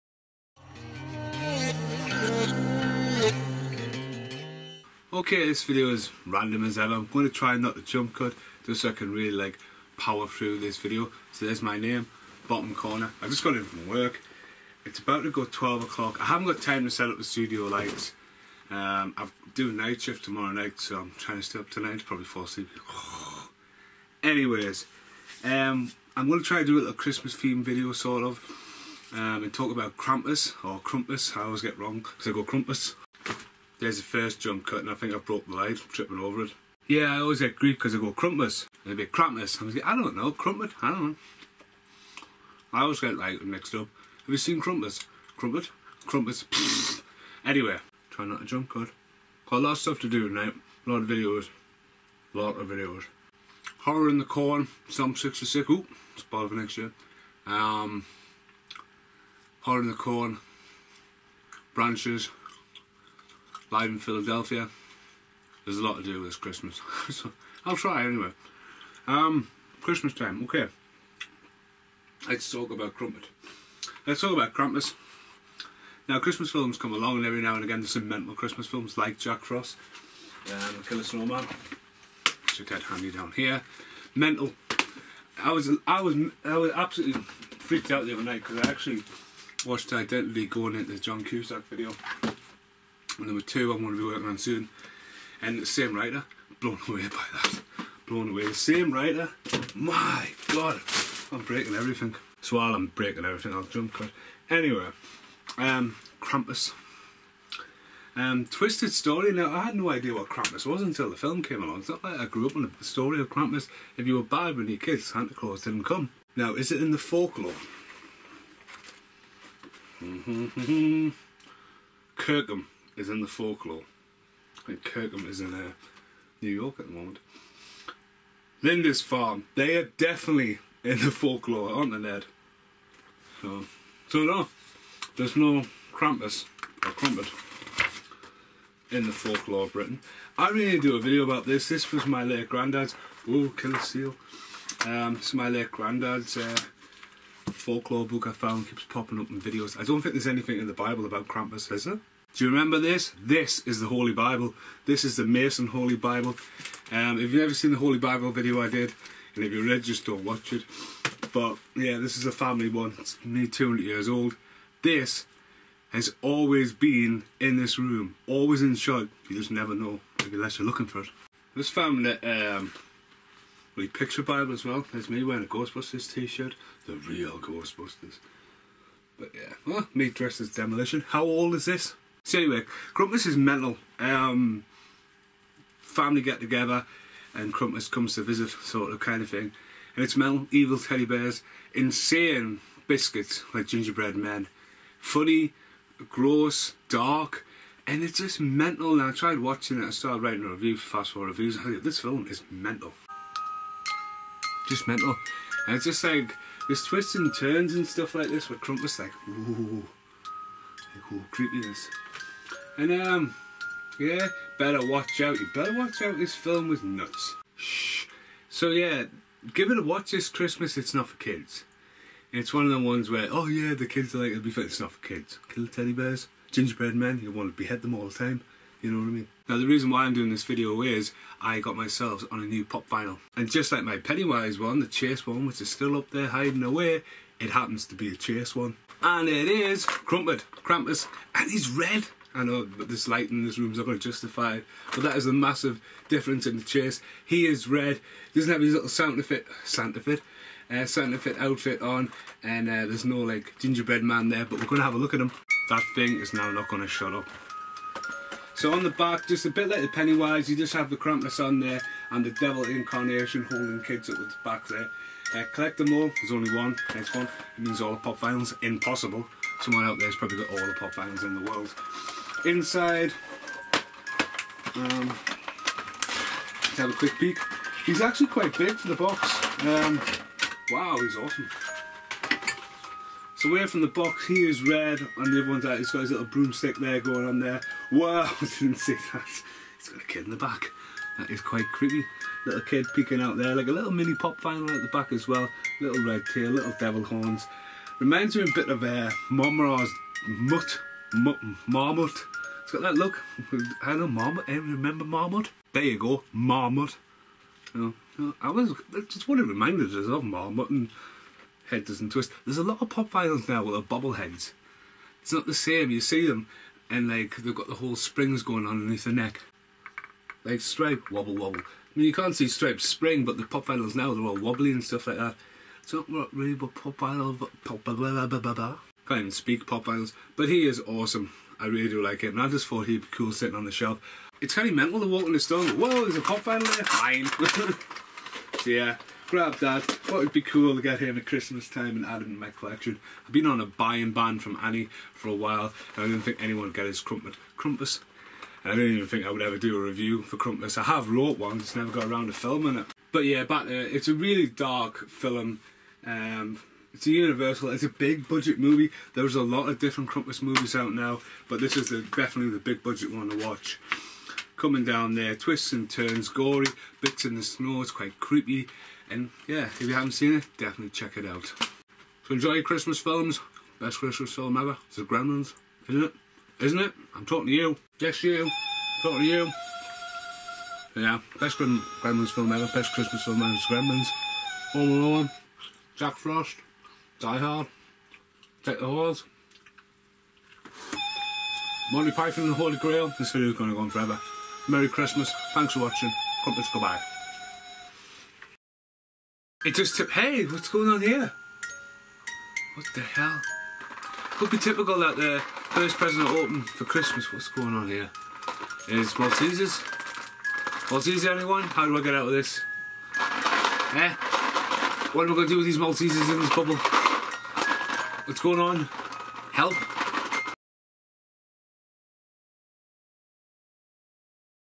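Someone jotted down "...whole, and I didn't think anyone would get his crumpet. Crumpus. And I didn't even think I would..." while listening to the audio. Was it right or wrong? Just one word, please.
wrong.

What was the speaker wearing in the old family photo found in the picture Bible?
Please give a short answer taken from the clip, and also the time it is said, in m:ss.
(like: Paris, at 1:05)
Ghostbusters t-shirt, at 2:55.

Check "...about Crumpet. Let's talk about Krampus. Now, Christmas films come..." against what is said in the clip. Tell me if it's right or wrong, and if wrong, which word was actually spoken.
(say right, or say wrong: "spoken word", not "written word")
right.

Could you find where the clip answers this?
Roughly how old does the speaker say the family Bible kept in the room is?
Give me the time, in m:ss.
2:43.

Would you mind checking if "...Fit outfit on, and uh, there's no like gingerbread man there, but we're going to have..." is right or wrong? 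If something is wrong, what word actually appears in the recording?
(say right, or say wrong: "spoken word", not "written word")
right.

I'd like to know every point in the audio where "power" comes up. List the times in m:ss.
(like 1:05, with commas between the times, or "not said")
0:09.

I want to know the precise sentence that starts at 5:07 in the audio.
You know, I was just what it reminded us of Marmot and Head Doesn't Twist.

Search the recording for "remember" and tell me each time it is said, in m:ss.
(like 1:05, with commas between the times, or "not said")
2:32, 5:04.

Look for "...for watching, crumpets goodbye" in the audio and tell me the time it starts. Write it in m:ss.
6:35.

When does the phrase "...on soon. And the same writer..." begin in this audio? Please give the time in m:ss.
1:34.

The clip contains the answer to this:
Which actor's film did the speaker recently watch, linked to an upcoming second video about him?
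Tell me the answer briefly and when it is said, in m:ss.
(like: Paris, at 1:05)
John Cusack, at 1:30.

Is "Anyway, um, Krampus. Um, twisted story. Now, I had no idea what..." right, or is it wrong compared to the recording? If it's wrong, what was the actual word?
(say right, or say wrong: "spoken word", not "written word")
right.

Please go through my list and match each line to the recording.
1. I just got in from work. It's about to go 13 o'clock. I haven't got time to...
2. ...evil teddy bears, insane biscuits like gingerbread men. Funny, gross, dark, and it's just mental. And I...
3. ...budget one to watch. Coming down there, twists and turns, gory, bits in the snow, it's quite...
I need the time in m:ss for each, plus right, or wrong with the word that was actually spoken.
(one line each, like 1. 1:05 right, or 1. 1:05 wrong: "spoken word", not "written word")
1. 0:13 wrong: "12", not "13"
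2. 3:10 right
3. 6:02 right.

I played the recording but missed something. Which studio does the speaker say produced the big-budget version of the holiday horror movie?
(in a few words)
Universal.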